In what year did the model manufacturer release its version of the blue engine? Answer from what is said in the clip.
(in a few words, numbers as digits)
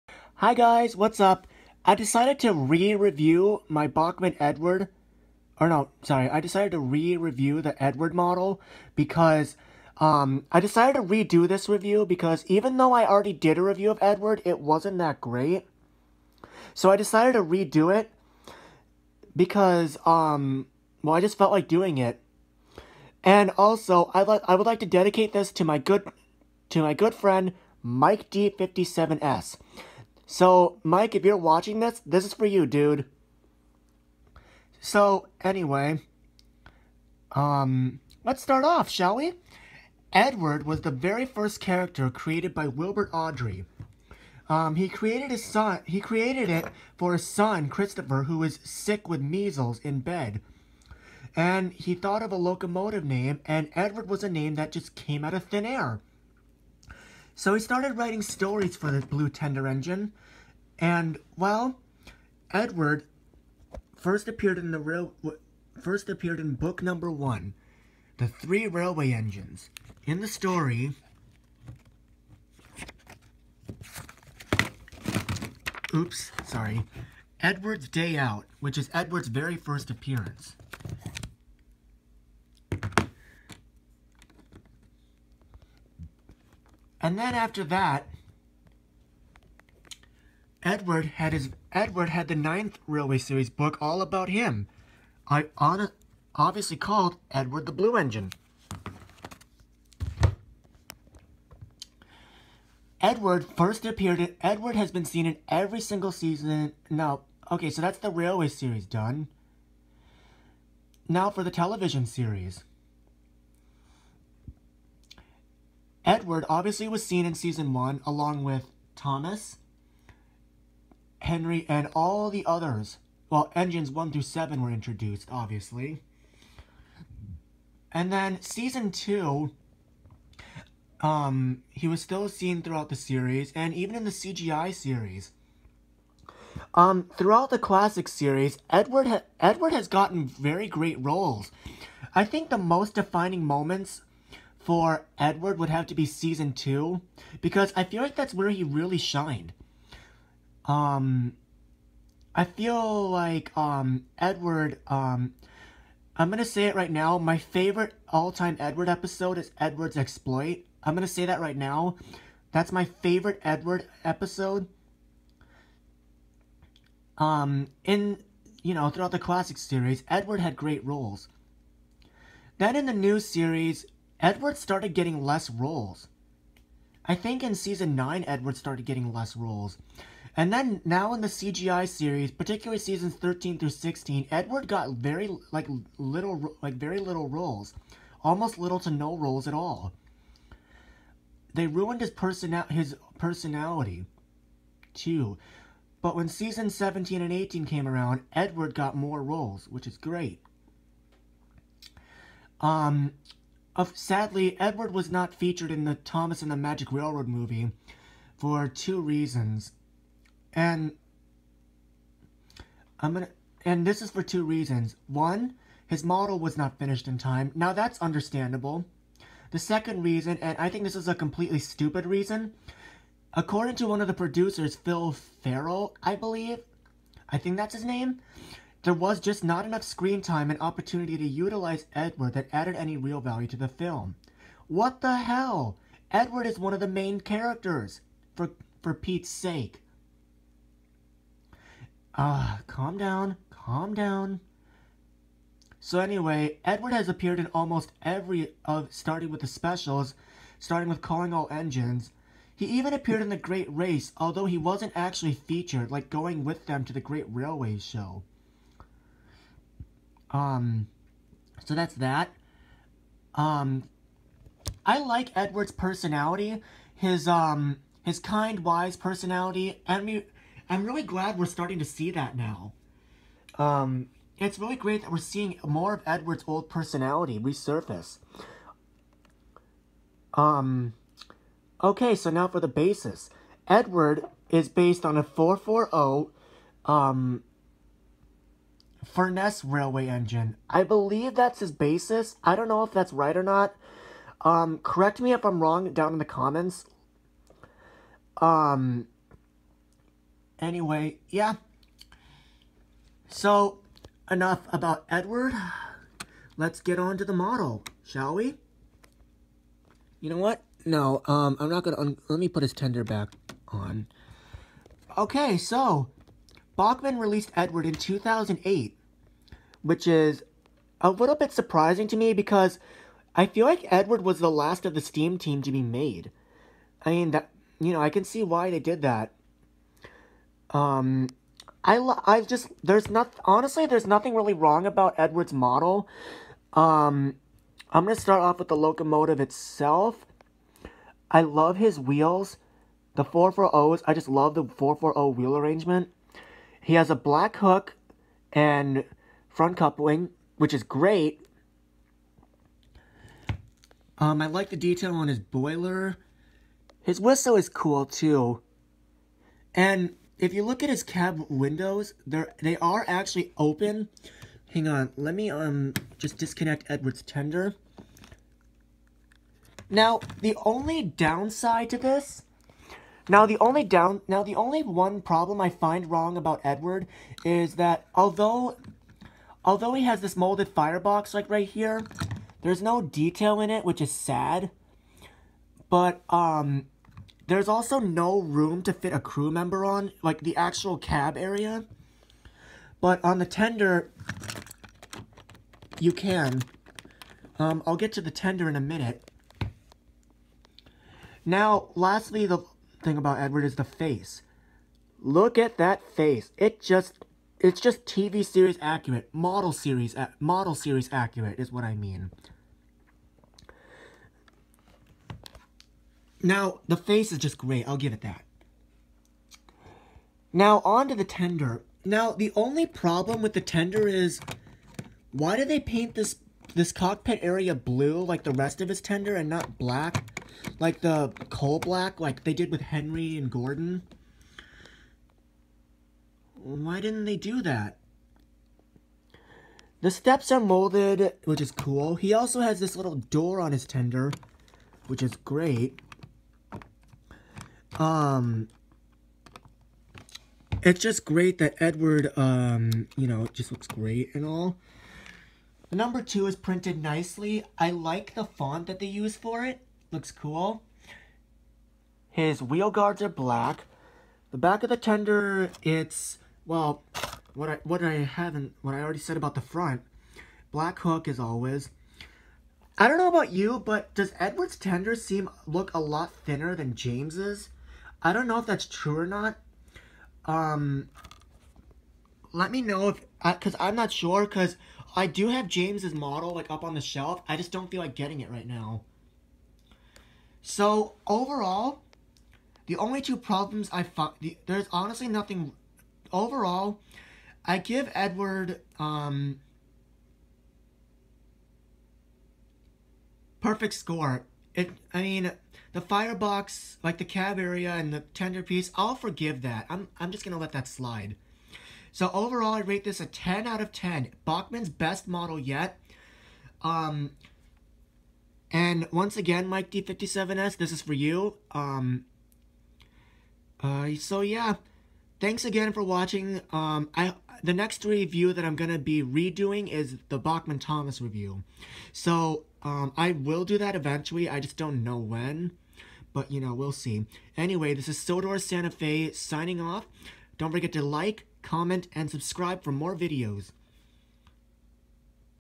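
2008.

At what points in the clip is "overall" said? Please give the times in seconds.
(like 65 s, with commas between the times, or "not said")
491 s, 496 s, 512 s.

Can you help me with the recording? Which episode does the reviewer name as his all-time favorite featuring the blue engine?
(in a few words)
Edward's exploit.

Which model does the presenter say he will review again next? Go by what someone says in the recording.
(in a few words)
Bachmann Thomas.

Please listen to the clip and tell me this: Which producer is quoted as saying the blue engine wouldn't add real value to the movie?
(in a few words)
Phil Fehrle.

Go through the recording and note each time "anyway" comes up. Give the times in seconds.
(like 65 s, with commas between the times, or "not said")
35 s, 245 s, 300 s, 537 s.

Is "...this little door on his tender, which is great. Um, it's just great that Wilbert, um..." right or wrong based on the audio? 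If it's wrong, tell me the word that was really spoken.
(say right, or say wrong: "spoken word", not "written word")
wrong: "Edward", not "Wilbert".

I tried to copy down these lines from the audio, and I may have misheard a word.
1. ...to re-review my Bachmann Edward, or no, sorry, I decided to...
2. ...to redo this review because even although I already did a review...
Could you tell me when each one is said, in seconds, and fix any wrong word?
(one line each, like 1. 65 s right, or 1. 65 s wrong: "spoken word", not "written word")
1. 2 s right
2. 10 s wrong: "though", not "although".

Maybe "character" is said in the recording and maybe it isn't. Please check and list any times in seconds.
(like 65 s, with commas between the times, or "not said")
41 s, 237 s.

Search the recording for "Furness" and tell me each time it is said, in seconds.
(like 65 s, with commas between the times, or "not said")
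289 s.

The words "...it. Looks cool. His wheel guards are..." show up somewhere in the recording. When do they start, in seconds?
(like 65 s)
459 s.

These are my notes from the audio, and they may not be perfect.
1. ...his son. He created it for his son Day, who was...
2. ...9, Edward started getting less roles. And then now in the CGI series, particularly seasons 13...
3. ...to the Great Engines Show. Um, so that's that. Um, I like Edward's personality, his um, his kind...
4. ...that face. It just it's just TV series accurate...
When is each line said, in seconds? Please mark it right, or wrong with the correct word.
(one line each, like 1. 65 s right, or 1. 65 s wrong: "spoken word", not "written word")
1. 45 s wrong: "Christopher", not "Day"
2. 177 s right
3. 256 s wrong: "Railway", not "Engines"
4. 405 s right.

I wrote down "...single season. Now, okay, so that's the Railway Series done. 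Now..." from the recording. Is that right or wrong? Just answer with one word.
right.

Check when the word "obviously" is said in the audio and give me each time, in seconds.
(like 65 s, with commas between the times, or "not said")
96 s, 116 s, 125 s.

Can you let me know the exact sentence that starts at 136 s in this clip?
Um, throughout the classic series, Edward ha Edward has gotten very great roles.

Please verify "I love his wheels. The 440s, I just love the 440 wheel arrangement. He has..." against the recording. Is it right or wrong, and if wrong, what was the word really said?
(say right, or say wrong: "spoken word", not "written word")
right.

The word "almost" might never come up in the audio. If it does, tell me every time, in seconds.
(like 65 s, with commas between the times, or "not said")
188 s, 247 s.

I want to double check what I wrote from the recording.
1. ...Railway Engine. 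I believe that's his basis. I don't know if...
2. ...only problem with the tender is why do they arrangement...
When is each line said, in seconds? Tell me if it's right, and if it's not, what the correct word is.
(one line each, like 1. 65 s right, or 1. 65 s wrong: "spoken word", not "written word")
1. 289 s right
2. 422 s wrong: "paint", not "arrangement".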